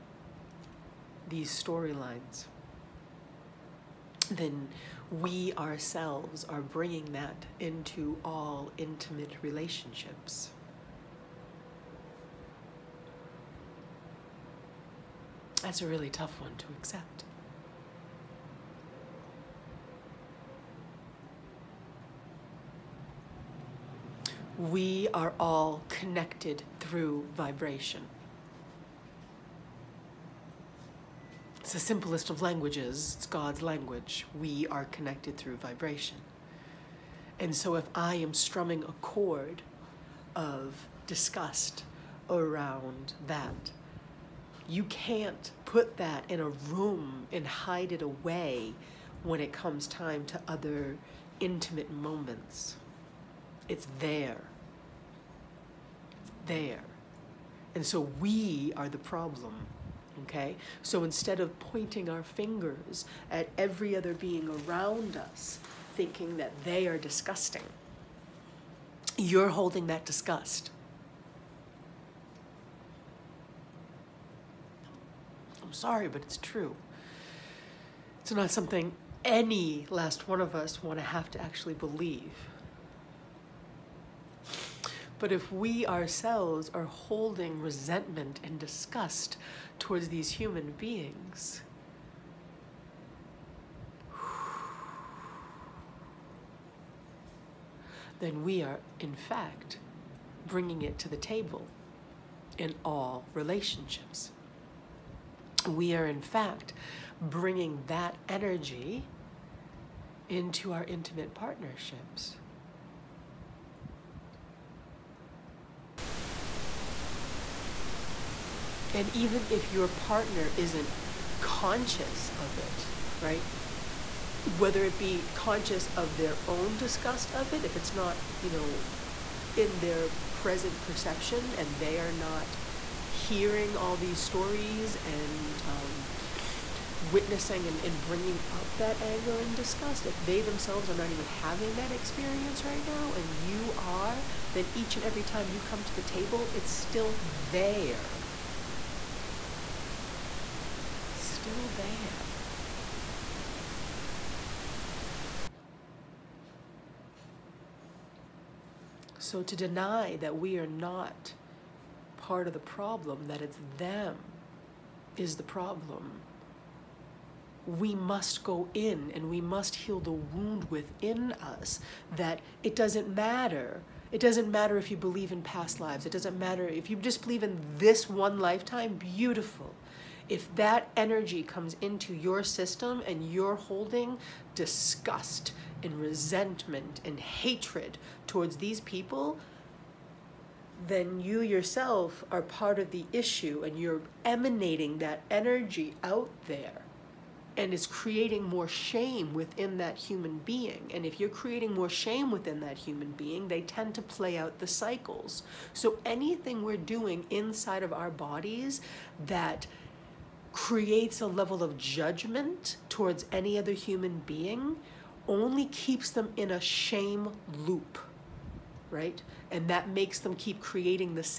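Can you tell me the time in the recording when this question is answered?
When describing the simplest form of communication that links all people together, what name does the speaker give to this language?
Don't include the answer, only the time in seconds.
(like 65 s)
33 s.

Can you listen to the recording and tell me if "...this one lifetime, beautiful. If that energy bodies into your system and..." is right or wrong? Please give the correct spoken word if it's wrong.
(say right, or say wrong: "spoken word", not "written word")
wrong: "comes", not "bodies".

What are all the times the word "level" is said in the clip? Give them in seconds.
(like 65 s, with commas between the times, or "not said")
211 s.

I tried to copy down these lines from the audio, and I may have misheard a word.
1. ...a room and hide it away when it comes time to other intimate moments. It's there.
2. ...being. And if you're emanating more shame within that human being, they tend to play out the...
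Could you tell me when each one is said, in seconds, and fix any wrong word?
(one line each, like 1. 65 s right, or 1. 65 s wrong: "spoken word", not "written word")
1. 46 s right
2. 200 s wrong: "creating", not "emanating".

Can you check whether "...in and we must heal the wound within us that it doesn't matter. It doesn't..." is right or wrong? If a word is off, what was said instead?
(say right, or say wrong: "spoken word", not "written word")
right.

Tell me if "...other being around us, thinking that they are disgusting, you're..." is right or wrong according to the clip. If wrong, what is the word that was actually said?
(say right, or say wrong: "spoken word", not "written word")
right.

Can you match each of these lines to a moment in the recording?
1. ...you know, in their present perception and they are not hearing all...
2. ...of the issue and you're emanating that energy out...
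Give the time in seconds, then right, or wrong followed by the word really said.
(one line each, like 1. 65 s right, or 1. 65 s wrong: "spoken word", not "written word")
1. 128 s right
2. 192 s right.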